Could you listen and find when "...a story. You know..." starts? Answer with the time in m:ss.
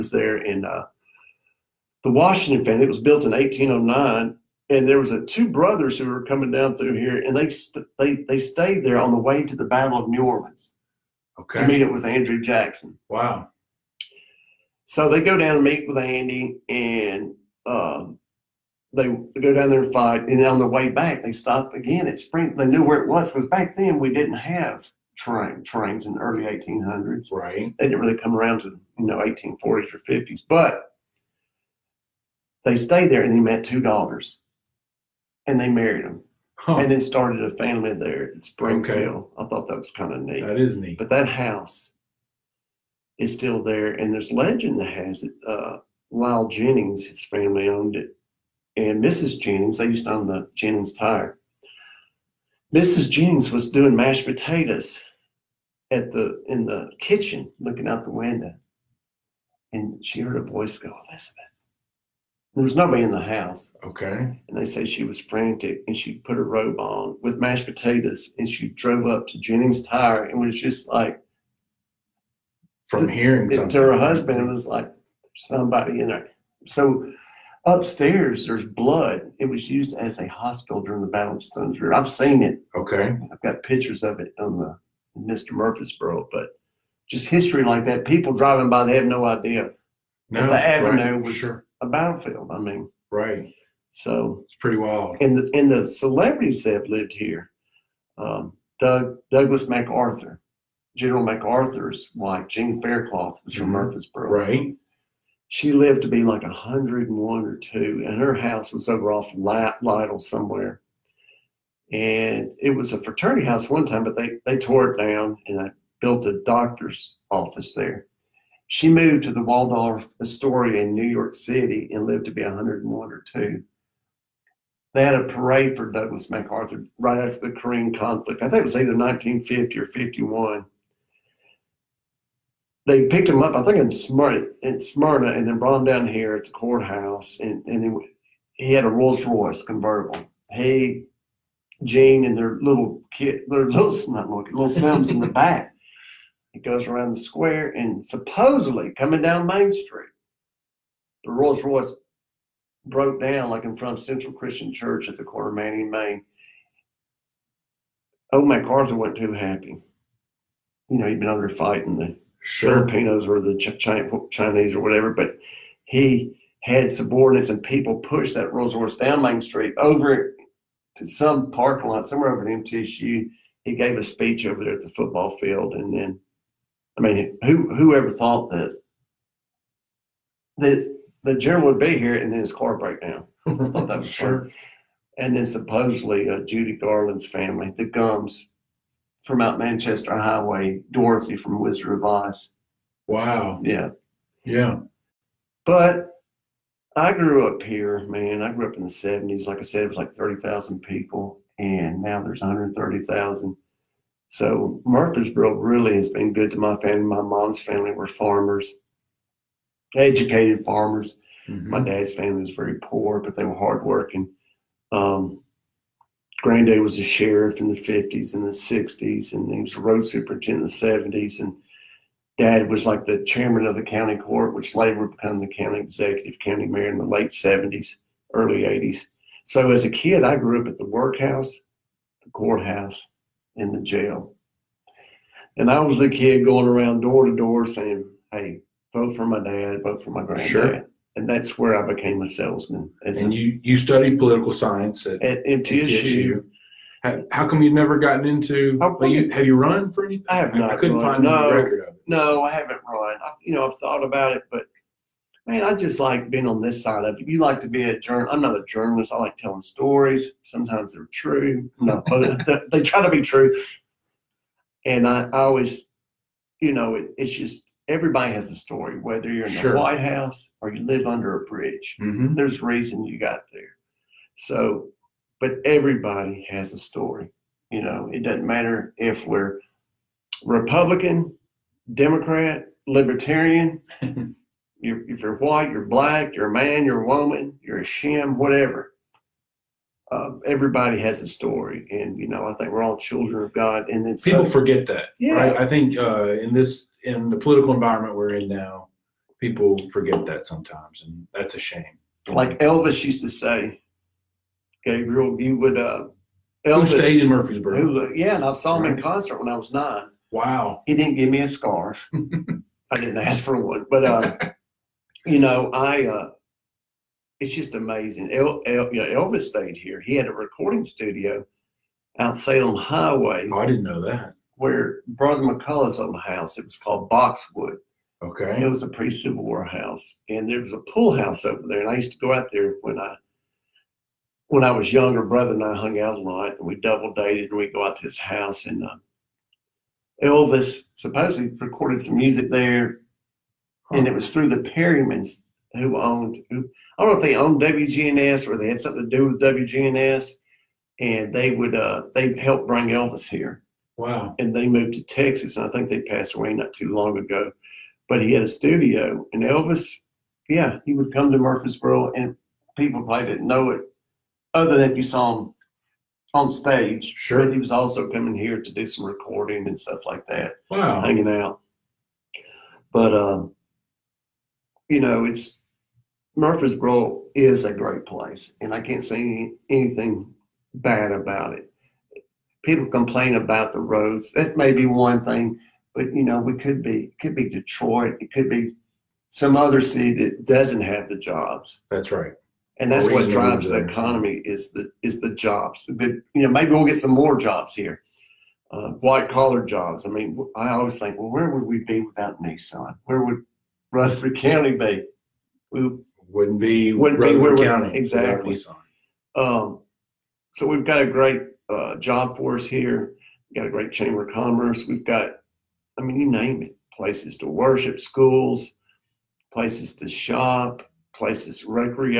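4:36.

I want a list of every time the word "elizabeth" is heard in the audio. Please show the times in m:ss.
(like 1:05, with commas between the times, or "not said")
1:01.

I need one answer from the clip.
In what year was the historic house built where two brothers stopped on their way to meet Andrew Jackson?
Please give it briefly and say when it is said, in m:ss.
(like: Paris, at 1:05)
1809, at 0:03.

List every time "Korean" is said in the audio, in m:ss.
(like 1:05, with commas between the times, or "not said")
2:07.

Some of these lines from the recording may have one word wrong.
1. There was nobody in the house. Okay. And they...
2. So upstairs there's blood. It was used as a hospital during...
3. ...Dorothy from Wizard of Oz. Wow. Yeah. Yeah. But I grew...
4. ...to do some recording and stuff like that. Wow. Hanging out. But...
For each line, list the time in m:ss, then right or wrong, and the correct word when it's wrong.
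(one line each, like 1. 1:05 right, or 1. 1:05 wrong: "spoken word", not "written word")
1. 1:02 right
2. 1:16 right
3. 3:10 right
4. 6:08 right.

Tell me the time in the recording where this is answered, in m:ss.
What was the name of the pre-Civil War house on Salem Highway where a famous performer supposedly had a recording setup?
5:27.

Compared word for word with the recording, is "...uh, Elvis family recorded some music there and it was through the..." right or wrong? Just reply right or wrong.
wrong.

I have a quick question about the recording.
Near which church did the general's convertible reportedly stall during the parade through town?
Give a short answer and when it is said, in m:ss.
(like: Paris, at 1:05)
Central Christian Church, at 2:34.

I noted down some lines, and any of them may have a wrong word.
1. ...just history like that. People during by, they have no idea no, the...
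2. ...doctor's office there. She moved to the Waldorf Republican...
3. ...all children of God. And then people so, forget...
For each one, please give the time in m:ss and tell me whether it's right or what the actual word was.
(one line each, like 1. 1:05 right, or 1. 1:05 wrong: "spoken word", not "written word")
1. 1:27 wrong: "driving", not "during"
2. 1:56 wrong: "Astoria", not "Republican"
3. 4:52 right.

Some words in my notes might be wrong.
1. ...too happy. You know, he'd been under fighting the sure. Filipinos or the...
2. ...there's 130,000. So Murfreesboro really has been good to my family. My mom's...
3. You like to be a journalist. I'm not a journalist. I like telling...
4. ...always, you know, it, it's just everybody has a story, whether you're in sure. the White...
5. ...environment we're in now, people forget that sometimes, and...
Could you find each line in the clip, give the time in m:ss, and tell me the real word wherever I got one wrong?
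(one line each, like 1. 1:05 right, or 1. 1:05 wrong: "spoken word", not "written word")
1. 2:39 right
2. 3:22 right
3. 4:17 right
4. 4:25 right
5. 4:57 right.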